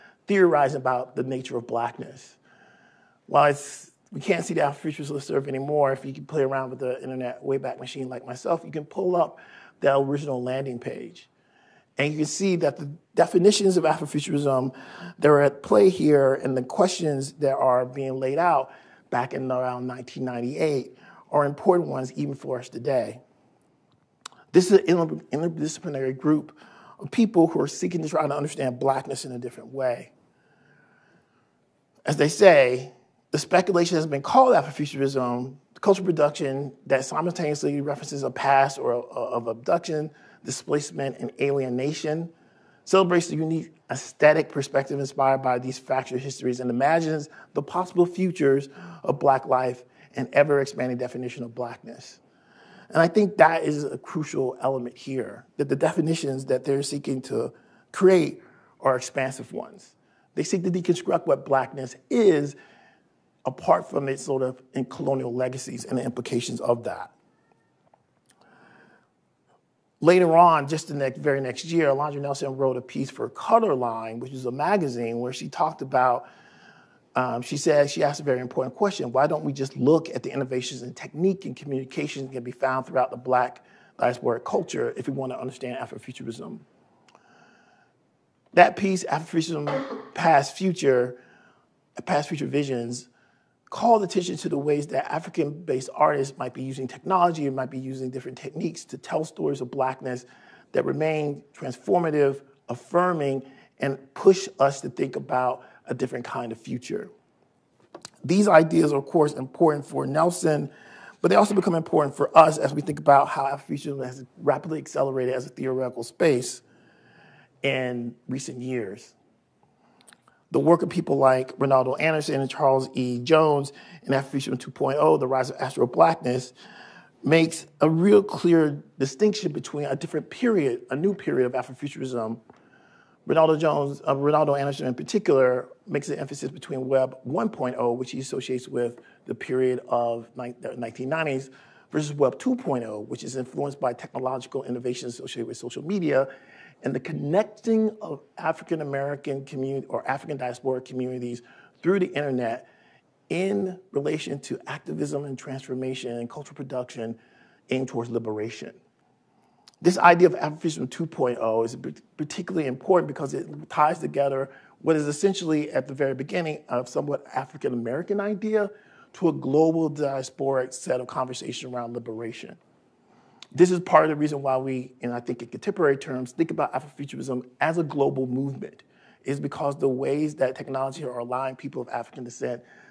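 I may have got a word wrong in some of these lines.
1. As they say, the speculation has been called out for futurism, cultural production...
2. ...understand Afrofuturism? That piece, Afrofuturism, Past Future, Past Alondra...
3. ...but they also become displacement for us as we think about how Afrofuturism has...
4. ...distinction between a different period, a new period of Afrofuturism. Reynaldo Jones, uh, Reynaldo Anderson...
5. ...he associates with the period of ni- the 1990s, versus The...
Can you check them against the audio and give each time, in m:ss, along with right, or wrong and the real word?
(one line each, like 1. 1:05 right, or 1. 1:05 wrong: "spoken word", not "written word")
1. 0:32 right
2. 1:25 wrong: "Future", not "Alondra"
3. 1:51 wrong: "important", not "displacement"
4. 2:08 right
5. 2:18 wrong: "Web", not "The".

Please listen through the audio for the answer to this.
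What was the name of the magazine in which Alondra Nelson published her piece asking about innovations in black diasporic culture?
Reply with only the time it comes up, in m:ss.
1:13.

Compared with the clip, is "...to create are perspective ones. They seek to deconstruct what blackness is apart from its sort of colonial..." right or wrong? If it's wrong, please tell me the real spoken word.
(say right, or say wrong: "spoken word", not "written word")
wrong: "expansive", not "perspective".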